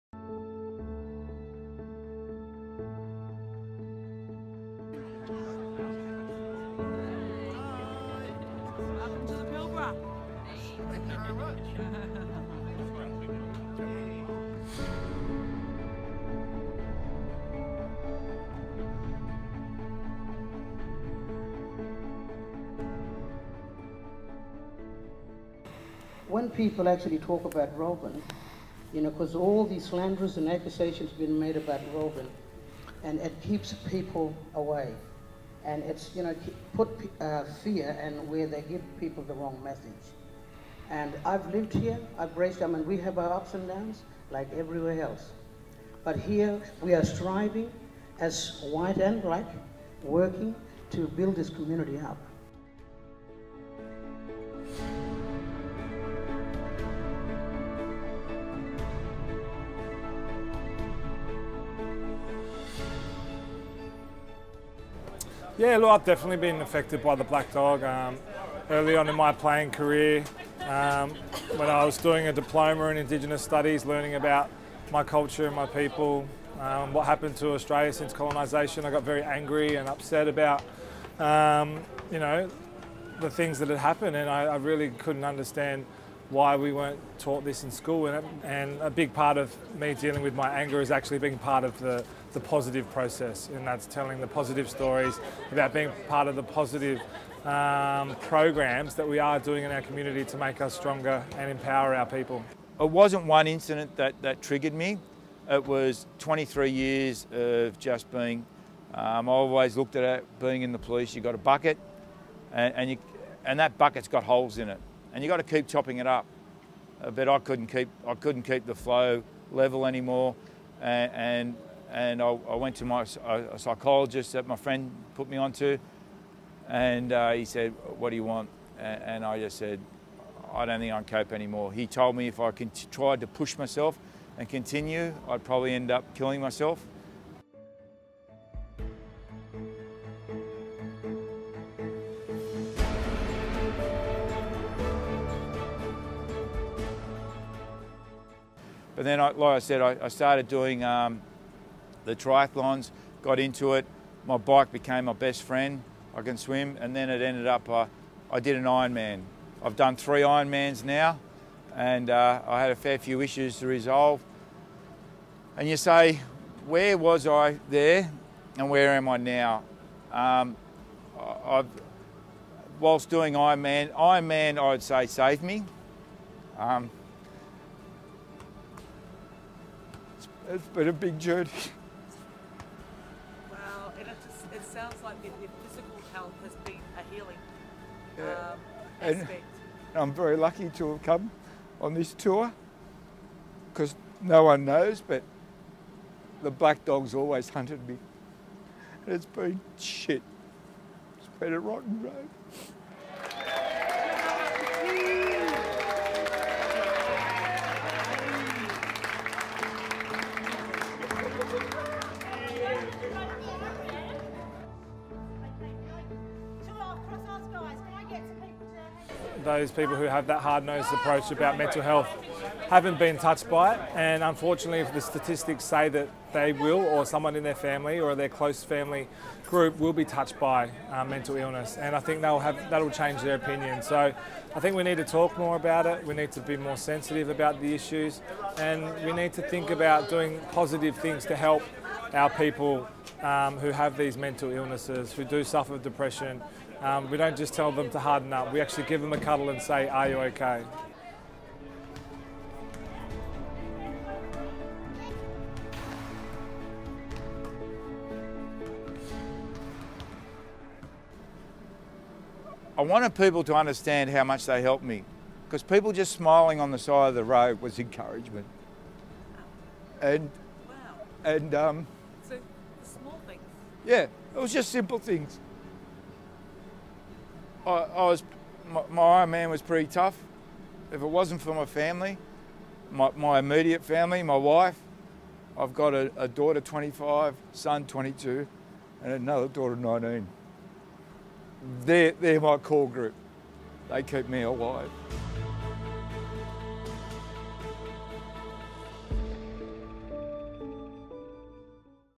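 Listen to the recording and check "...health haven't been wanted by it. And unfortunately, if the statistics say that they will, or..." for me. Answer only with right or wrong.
wrong.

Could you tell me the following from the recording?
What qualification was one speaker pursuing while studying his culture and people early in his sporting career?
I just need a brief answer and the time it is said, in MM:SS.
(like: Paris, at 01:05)
Diploma in Indigenous Studies, at 01:12.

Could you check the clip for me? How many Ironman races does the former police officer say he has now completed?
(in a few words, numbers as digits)
3.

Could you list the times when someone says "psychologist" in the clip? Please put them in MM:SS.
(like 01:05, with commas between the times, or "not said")
02:03.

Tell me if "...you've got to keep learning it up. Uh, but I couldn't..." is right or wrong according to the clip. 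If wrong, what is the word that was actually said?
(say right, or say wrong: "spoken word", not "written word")
wrong: "chopping", not "learning".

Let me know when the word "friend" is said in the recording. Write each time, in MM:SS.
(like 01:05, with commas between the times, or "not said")
02:04, 02:35.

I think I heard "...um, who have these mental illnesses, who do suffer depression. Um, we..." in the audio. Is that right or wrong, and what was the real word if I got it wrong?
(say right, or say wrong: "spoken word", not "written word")
right.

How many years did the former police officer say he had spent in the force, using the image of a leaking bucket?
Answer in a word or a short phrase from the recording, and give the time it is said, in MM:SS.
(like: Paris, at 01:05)
23, at 01:46.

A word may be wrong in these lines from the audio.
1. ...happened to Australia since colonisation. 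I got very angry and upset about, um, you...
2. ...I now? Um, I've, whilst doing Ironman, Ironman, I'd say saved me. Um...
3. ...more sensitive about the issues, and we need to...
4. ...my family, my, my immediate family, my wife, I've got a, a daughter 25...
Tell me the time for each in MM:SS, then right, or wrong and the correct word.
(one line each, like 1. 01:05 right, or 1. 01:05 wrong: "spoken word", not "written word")
1. 01:17 right
2. 02:49 right
3. 03:56 right
4. 04:41 right.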